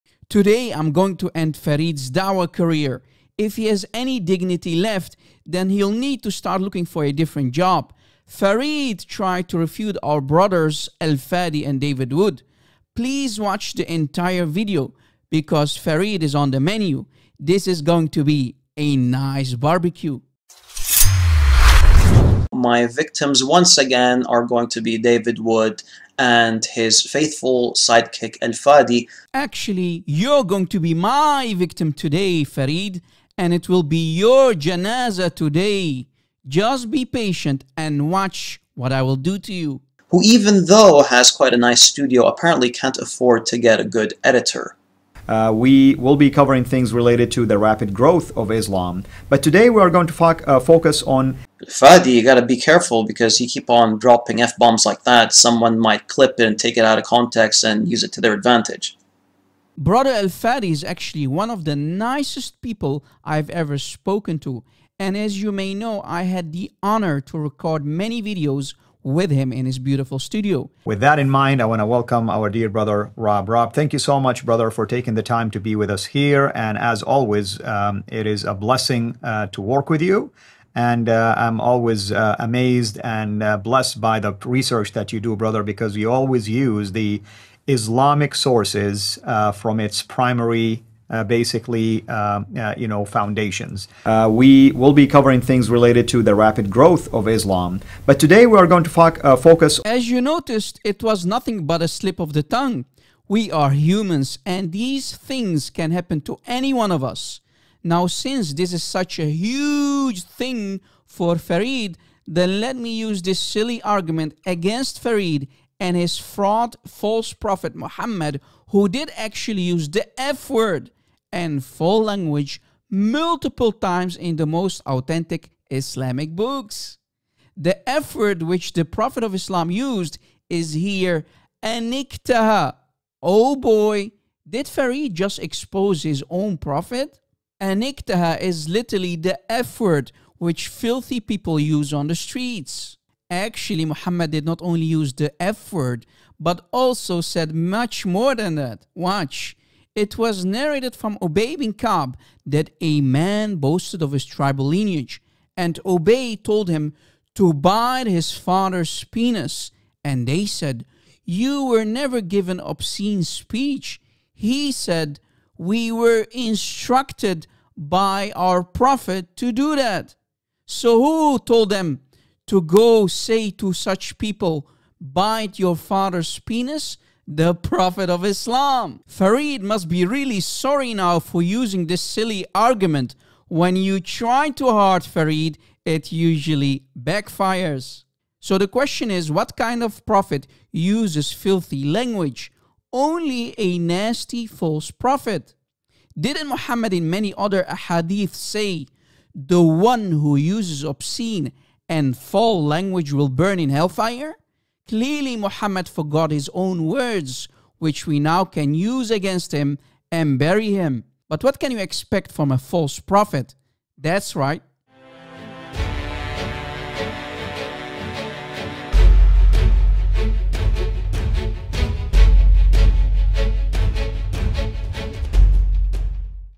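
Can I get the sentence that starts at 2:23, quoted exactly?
Actually, Muhammad did not only use the F word, but also said much more than that.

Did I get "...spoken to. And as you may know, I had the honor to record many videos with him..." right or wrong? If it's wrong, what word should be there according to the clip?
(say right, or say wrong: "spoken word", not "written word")
right.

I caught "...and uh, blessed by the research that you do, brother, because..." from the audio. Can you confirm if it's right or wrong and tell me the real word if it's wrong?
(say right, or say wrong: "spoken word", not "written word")
right.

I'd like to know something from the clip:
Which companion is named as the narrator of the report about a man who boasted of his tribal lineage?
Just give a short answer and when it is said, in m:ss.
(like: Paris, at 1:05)
Ubayy bin Ka'b, at 2:31.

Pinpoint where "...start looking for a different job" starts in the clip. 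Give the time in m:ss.
0:06.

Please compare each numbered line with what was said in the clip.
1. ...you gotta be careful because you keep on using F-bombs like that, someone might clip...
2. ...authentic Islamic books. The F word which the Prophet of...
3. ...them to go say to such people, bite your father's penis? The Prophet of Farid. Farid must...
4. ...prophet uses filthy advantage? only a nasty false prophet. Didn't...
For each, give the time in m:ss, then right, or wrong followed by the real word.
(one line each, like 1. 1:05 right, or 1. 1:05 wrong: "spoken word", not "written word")
1. 0:52 wrong: "dropping", not "using"
2. 2:04 right
3. 2:51 wrong: "Islam", not "Farid"
4. 3:10 wrong: "language", not "advantage".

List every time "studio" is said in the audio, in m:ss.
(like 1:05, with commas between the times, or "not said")
0:41, 1:10.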